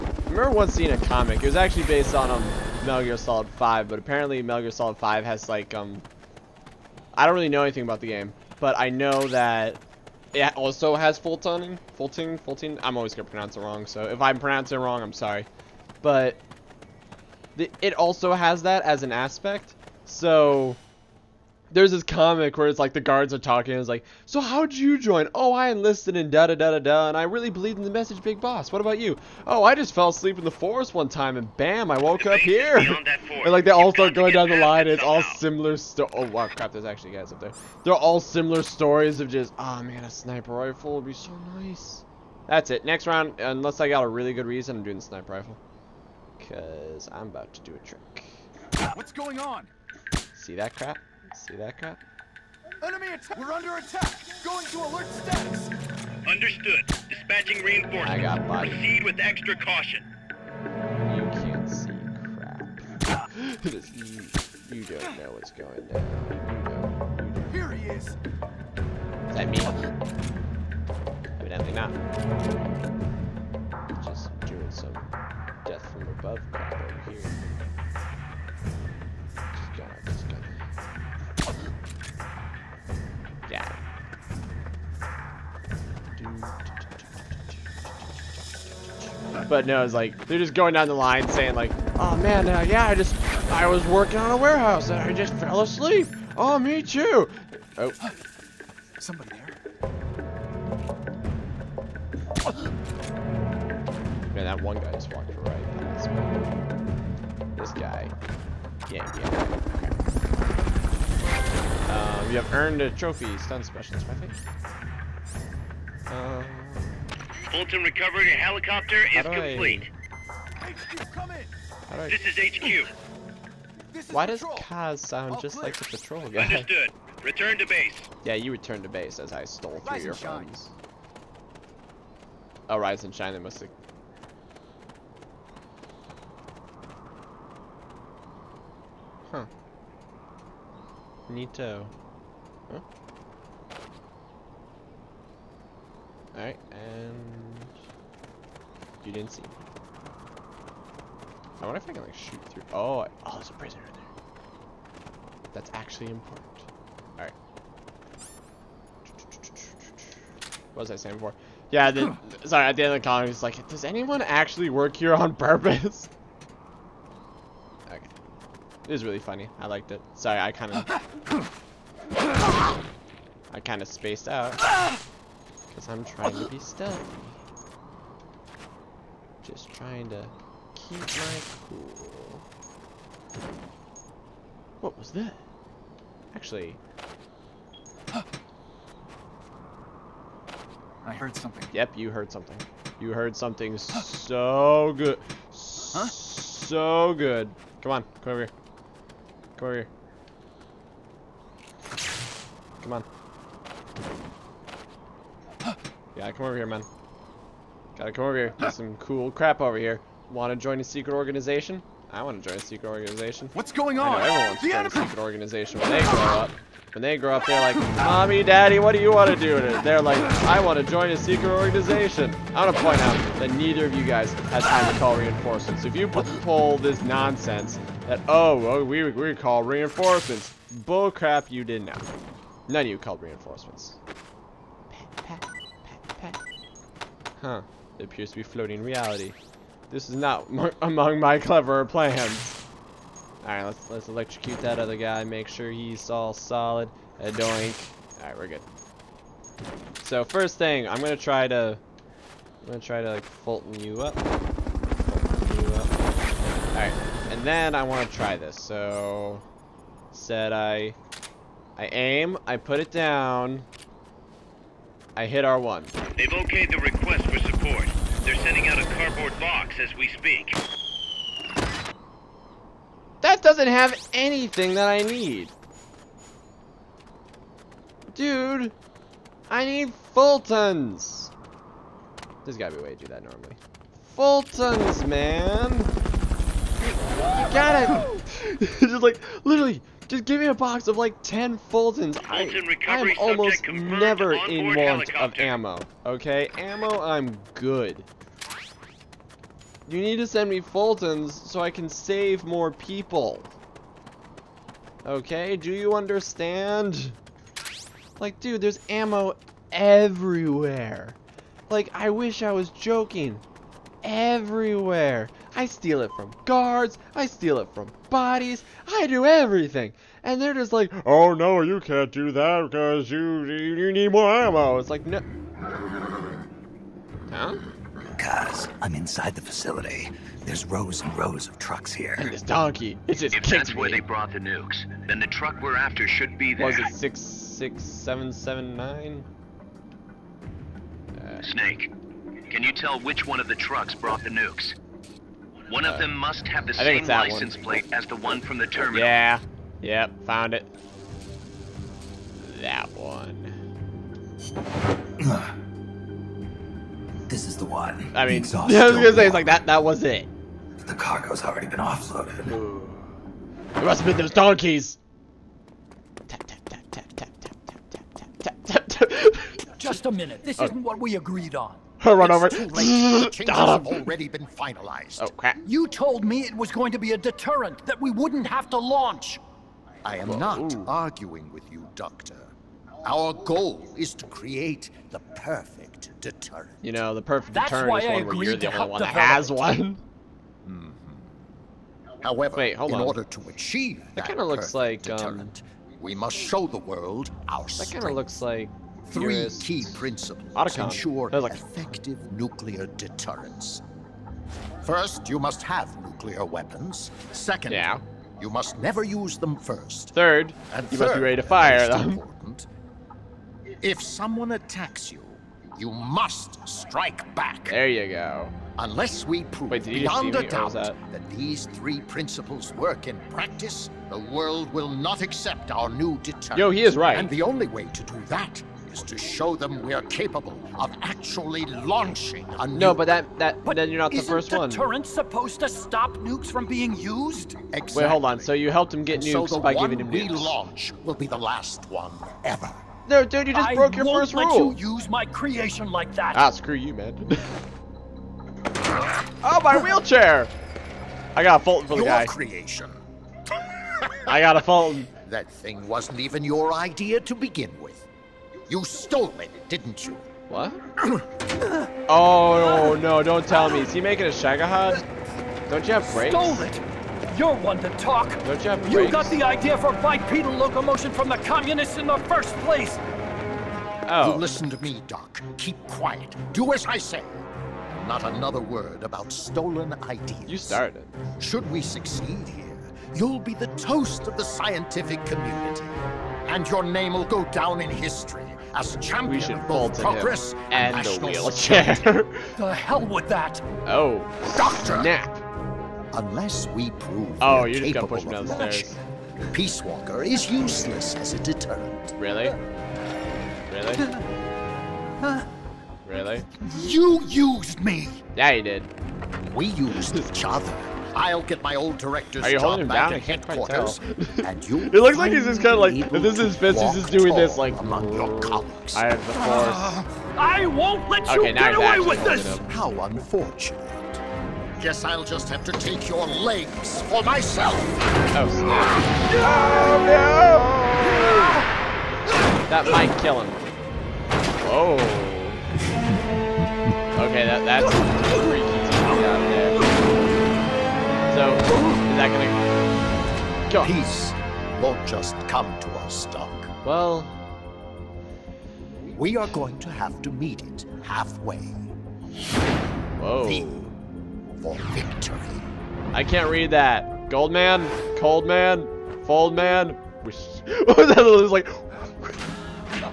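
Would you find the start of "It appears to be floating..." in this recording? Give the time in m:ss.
3:57.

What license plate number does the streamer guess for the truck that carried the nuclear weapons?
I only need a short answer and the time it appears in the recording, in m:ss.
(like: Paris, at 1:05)
66779, at 5:36.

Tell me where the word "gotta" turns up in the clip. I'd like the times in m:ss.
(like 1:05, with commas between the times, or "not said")
3:27, 4:42, 4:47.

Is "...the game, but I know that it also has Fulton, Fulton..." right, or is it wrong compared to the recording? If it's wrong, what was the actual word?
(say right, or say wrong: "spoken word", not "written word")
right.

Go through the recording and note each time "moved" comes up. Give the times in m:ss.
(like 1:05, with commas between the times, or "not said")
not said.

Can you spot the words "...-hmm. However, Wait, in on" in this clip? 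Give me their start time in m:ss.
6:30.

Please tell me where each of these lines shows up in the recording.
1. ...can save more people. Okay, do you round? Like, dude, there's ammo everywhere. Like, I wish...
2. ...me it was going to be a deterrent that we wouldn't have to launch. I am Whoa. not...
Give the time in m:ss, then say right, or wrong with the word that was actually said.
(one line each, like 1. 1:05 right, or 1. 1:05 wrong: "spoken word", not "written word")
1. 5:01 wrong: "understand", not "round"
2. 6:16 right.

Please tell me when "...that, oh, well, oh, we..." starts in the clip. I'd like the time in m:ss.
3:48.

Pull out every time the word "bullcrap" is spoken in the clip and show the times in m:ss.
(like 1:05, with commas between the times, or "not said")
3:50.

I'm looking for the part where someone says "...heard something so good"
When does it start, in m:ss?
3:13.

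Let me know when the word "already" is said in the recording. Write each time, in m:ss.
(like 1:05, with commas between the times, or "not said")
6:01, 6:13.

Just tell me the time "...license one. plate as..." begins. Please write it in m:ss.
5:47.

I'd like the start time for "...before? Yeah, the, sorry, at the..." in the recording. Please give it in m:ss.
2:41.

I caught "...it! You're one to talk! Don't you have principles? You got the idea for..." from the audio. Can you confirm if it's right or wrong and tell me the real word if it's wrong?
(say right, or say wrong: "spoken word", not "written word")
wrong: "brakes", not "principles".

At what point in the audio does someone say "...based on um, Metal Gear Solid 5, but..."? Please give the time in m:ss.
0:01.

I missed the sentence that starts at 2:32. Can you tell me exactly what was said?
Oh, I, oh, there's a prisoner in there.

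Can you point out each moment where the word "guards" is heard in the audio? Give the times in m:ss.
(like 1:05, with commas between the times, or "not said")
0:22, 5:16.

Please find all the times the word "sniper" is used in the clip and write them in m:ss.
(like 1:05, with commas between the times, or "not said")
0:40, 0:45.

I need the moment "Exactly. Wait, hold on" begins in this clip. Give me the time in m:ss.
7:17.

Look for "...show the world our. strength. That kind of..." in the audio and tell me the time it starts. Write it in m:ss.
6:36.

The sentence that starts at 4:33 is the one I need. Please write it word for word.
That doesn't have anything that I need.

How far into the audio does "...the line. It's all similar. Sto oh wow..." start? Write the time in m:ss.
0:34.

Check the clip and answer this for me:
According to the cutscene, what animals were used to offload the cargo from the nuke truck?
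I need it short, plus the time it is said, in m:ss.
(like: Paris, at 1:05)
Donkeys, at 6:04.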